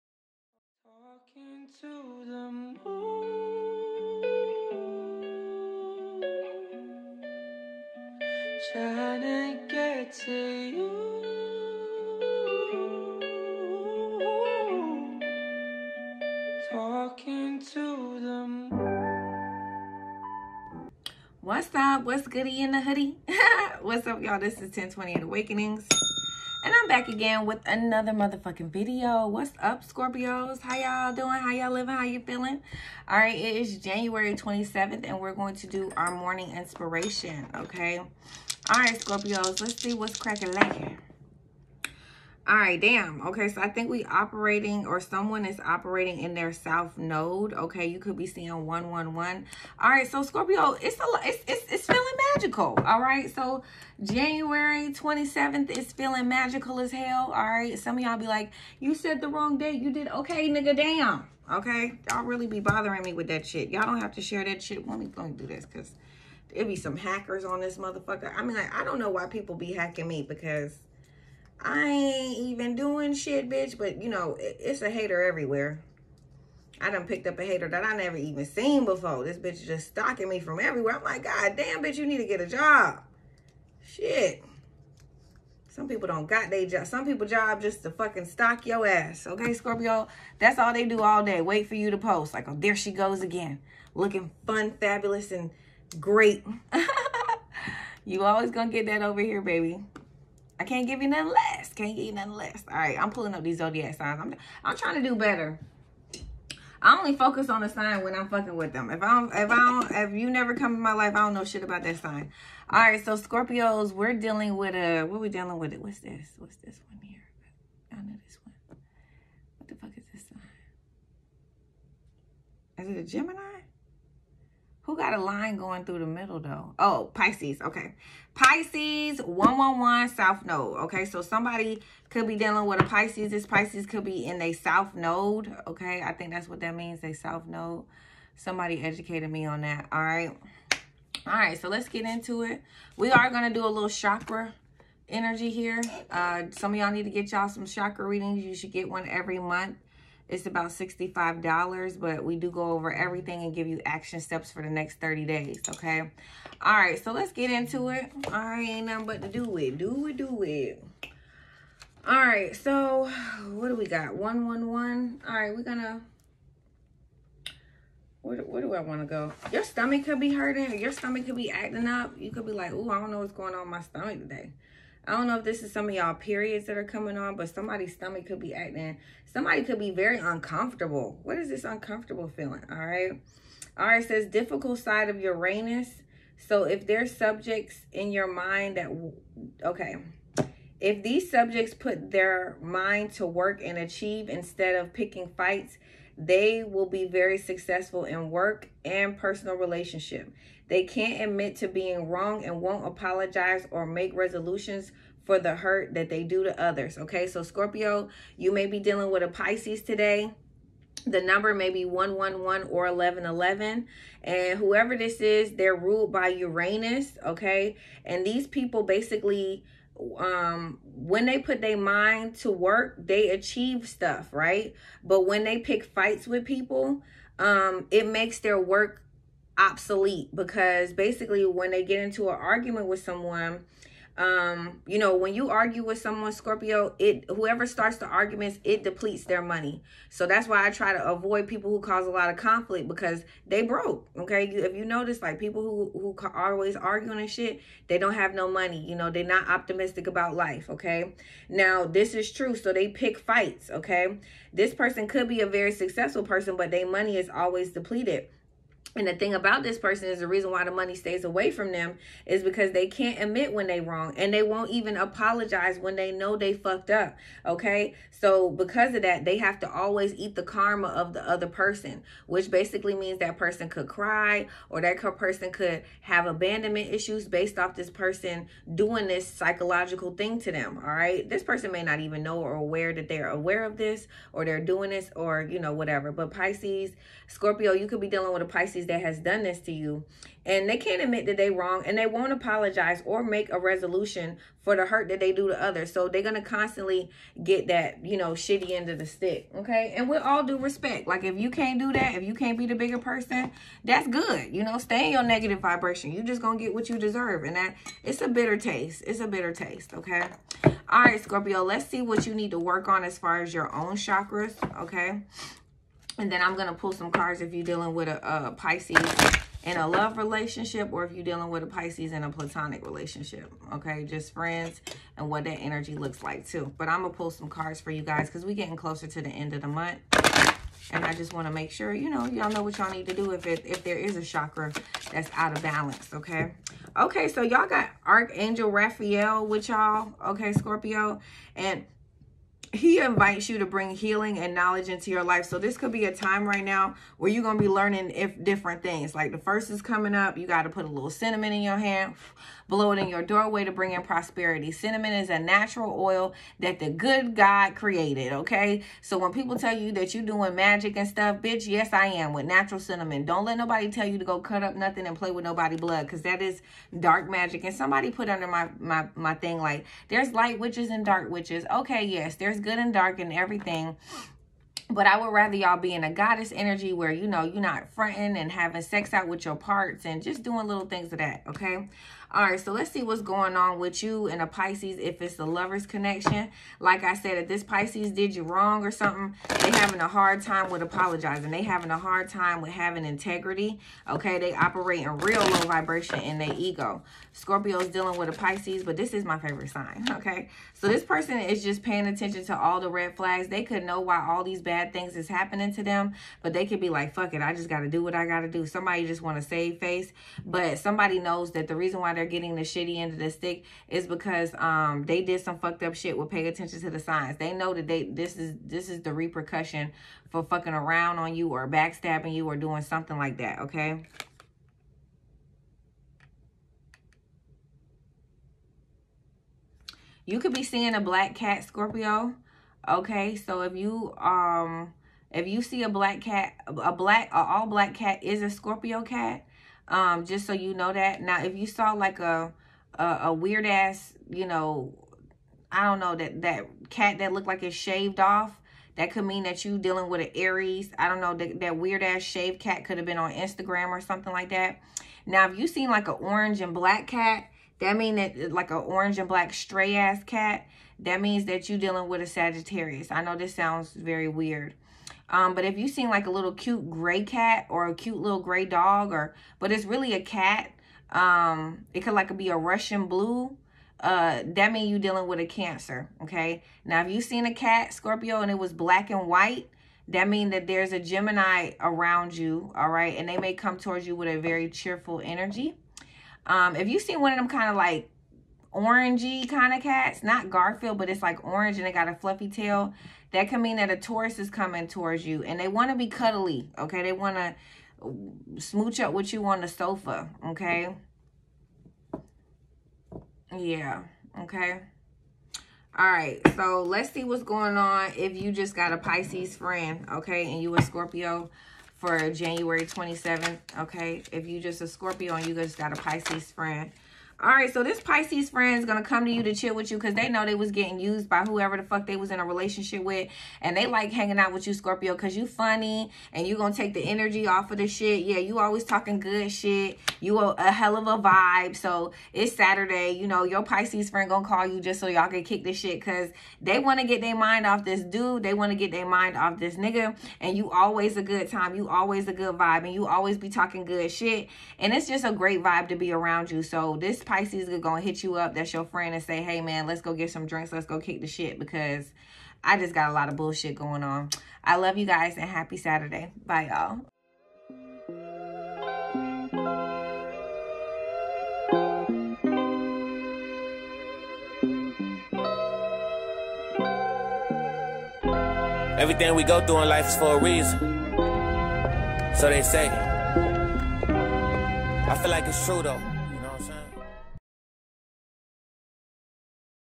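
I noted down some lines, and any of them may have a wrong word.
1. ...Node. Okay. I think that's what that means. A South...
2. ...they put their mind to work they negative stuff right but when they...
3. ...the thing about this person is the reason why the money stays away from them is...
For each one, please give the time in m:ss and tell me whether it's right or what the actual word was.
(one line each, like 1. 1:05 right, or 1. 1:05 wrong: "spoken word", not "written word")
1. 2:14 right
2. 3:41 wrong: "achieve", not "negative"
3. 4:19 right.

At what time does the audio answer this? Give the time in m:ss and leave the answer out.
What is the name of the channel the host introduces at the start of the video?
0:24.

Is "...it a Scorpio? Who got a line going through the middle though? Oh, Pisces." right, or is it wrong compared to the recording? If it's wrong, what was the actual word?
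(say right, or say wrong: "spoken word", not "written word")
wrong: "Gemini", not "Scorpio".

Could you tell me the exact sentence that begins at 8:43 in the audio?
And they like hanging out with you, Scorpio, because you funny and you going to take the energy off of the shit.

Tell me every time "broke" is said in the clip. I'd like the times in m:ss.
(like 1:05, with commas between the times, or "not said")
4:03.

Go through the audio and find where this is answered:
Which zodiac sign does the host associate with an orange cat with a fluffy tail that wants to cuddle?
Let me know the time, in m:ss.
8:13.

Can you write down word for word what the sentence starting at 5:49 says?
Like the first is coming up.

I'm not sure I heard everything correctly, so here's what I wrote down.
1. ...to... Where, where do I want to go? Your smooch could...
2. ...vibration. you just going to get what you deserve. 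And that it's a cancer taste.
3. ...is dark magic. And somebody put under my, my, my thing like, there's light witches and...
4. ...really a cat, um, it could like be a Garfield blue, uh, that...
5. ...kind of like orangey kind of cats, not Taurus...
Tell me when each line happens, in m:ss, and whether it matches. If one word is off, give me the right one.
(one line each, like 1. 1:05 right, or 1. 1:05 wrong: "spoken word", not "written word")
1. 2:45 wrong: "stomach", not "smooch"
2. 5:05 wrong: "bitter", not "cancer"
3. 6:06 right
4. 7:49 wrong: "Russian", not "Garfield"
5. 8:07 wrong: "Garfield", not "Taurus".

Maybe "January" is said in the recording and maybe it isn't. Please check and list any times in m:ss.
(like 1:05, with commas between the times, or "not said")
0:33, 0:54, 8:32.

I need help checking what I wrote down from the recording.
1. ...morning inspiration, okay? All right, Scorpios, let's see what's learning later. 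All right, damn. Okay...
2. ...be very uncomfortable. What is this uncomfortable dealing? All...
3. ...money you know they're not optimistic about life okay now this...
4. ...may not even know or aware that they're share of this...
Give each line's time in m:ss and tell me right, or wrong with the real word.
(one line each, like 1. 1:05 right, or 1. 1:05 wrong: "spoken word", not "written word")
1. 0:36 wrong: "cracking", not "learning"
2. 2:59 wrong: "feeling", not "dealing"
3. 4:08 right
4. 4:41 wrong: "aware", not "share".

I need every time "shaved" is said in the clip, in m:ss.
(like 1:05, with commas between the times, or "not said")
7:27, 7:32.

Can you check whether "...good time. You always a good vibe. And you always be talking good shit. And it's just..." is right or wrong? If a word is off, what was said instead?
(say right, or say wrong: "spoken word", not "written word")
right.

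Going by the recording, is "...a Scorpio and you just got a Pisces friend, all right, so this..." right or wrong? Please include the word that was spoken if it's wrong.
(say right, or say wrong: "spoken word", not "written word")
right.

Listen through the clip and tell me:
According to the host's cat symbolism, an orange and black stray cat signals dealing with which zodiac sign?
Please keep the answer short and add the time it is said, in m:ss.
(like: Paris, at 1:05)
Sagittarius, at 7:42.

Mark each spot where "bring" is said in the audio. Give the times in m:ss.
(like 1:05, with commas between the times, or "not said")
5:43, 5:53.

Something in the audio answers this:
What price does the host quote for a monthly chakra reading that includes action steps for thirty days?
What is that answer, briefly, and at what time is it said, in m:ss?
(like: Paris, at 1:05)
$65, at 2:30.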